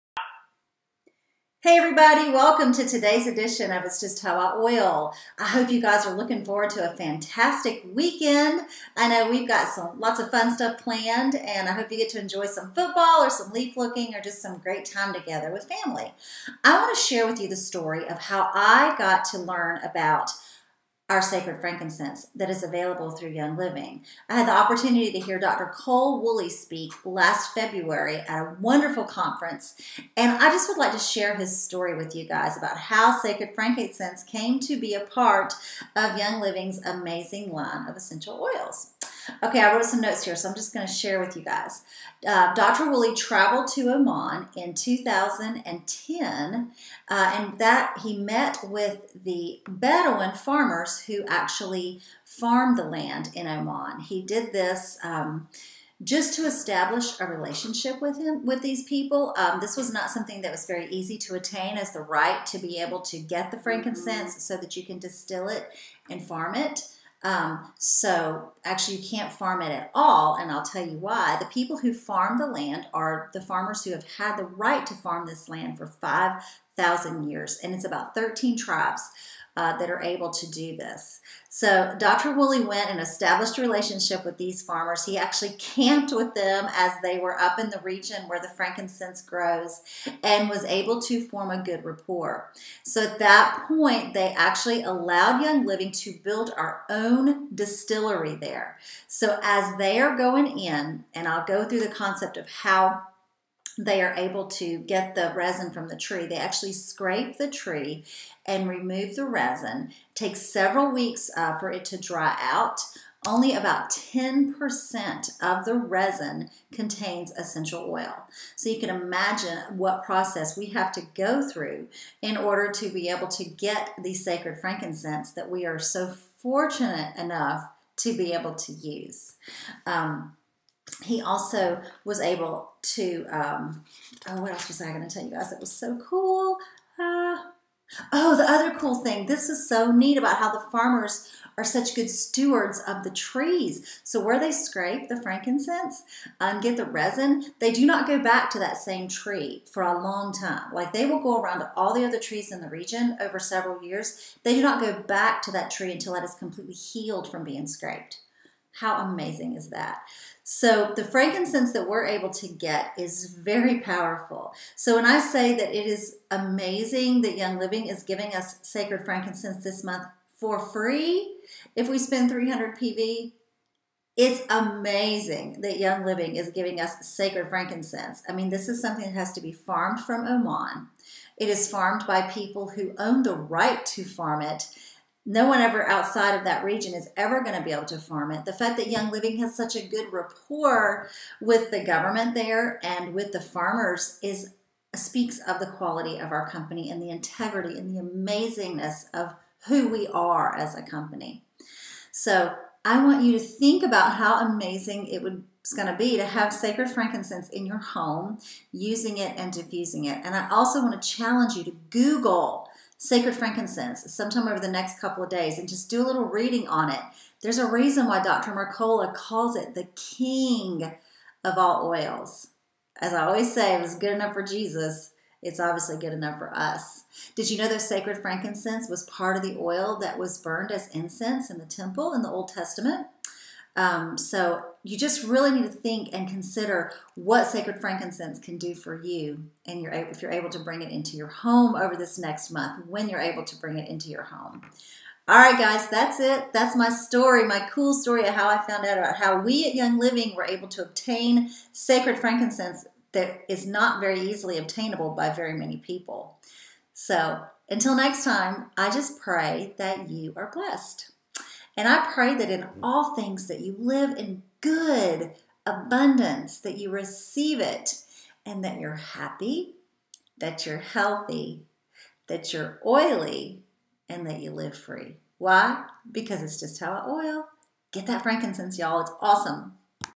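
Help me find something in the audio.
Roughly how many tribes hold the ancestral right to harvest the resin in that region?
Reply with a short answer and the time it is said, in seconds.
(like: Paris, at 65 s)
13, at 78 s.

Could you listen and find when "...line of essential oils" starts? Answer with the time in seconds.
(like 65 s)
37 s.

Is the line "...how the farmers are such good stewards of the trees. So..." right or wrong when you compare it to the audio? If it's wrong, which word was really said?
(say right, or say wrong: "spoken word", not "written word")
right.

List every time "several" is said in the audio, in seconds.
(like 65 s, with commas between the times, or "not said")
110 s, 153 s.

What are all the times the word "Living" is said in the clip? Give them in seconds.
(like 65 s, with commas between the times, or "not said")
23 s, 36 s, 95 s, 167 s, 176 s, 189 s, 249 s.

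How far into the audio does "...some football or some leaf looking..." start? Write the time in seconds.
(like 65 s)
12 s.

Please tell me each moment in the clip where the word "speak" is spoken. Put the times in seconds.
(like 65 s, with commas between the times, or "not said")
26 s, 194 s.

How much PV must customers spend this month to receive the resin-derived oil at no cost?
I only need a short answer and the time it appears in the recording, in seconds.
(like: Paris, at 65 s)
300 PV, at 172 s.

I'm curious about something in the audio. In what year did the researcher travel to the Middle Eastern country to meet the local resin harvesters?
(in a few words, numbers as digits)
2010.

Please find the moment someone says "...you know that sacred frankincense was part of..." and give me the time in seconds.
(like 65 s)
227 s.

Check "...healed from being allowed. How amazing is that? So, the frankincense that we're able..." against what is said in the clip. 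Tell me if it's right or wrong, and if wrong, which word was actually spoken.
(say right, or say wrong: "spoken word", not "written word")
wrong: "scraped", not "allowed".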